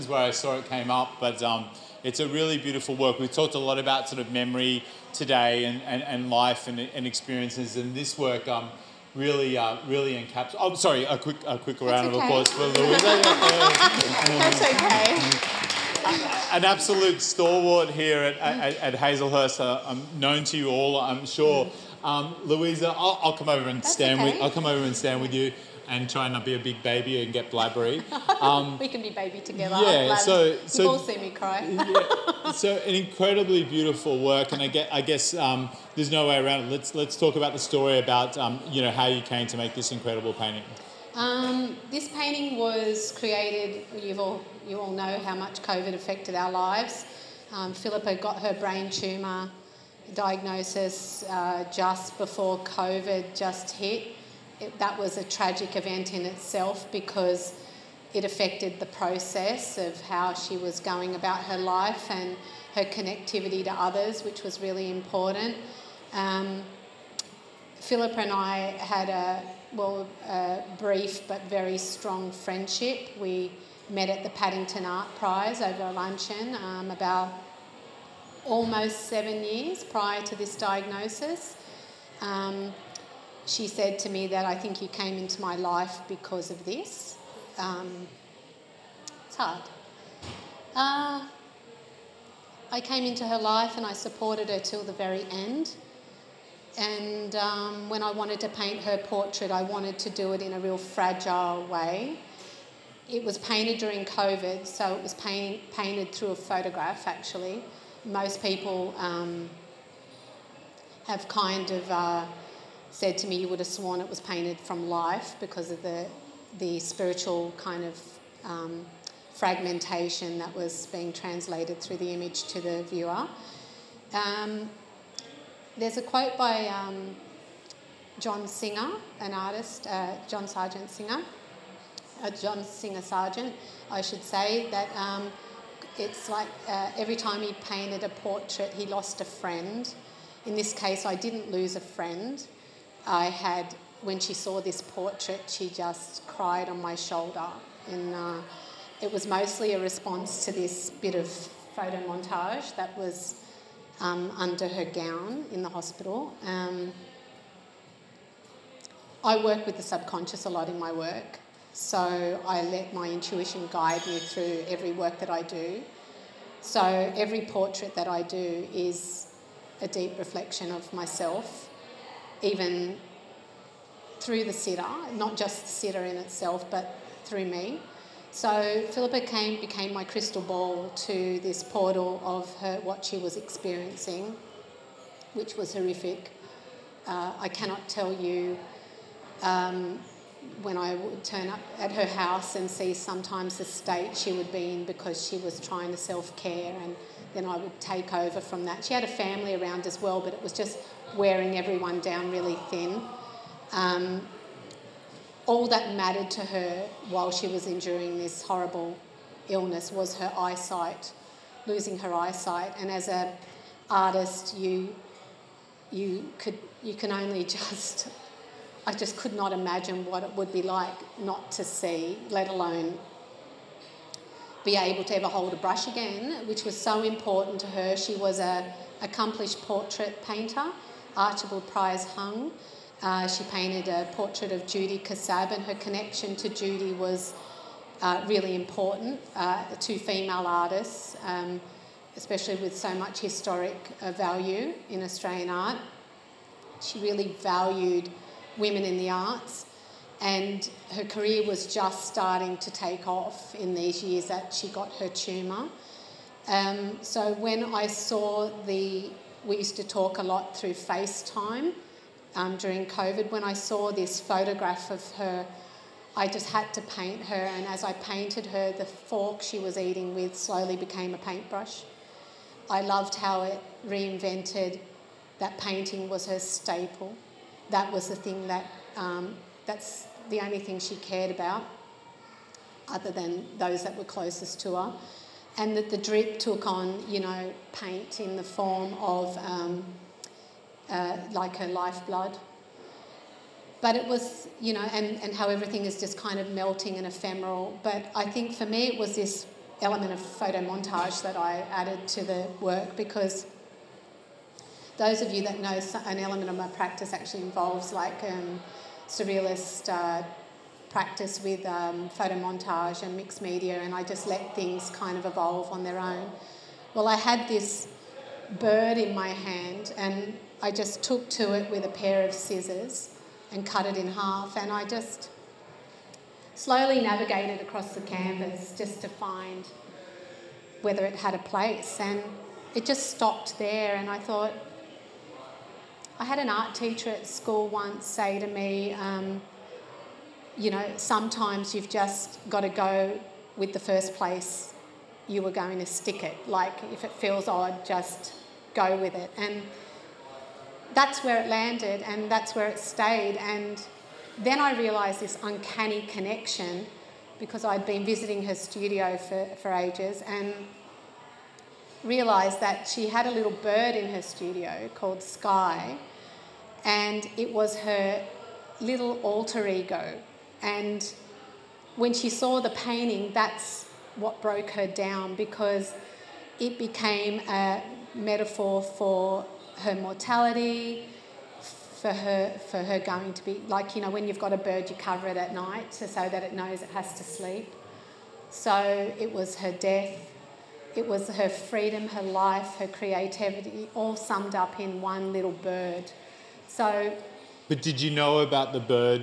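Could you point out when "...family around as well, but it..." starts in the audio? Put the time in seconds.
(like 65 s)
199 s.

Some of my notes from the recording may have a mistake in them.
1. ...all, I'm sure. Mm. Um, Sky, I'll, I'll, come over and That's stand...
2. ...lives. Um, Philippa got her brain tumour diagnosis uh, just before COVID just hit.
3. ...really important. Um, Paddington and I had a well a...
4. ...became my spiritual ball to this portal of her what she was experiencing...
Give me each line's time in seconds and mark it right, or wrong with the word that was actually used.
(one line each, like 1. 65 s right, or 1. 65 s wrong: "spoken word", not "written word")
1. 20 s wrong: "Louisa", not "Sky"
2. 46 s right
3. 64 s wrong: "Philippa", not "Paddington"
4. 179 s wrong: "crystal", not "spiritual".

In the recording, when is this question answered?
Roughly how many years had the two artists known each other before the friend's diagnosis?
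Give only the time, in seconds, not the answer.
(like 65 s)
79 s.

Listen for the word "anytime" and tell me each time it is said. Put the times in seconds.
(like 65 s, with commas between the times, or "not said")
not said.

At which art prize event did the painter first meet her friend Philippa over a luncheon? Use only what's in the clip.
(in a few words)
Paddington Art Prize.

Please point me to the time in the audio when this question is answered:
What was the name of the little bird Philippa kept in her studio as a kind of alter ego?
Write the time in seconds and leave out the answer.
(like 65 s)
365 s.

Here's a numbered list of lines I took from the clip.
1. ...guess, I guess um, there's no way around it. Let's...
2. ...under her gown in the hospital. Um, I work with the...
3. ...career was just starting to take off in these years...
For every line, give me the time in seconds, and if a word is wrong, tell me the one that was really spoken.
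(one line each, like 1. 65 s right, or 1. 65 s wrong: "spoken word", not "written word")
1. 34 s right
2. 154 s right
3. 251 s right.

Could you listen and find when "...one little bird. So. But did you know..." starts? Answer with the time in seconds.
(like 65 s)
395 s.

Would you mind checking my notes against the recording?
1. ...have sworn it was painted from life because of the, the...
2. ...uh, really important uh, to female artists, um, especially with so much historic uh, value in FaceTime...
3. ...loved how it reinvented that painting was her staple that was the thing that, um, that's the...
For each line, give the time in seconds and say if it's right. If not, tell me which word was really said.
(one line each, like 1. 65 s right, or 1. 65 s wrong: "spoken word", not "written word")
1. 113 s right
2. 238 s wrong: "Australian", not "FaceTime"
3. 272 s right.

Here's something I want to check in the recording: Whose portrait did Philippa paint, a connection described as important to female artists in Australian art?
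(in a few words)
Judy Cassab.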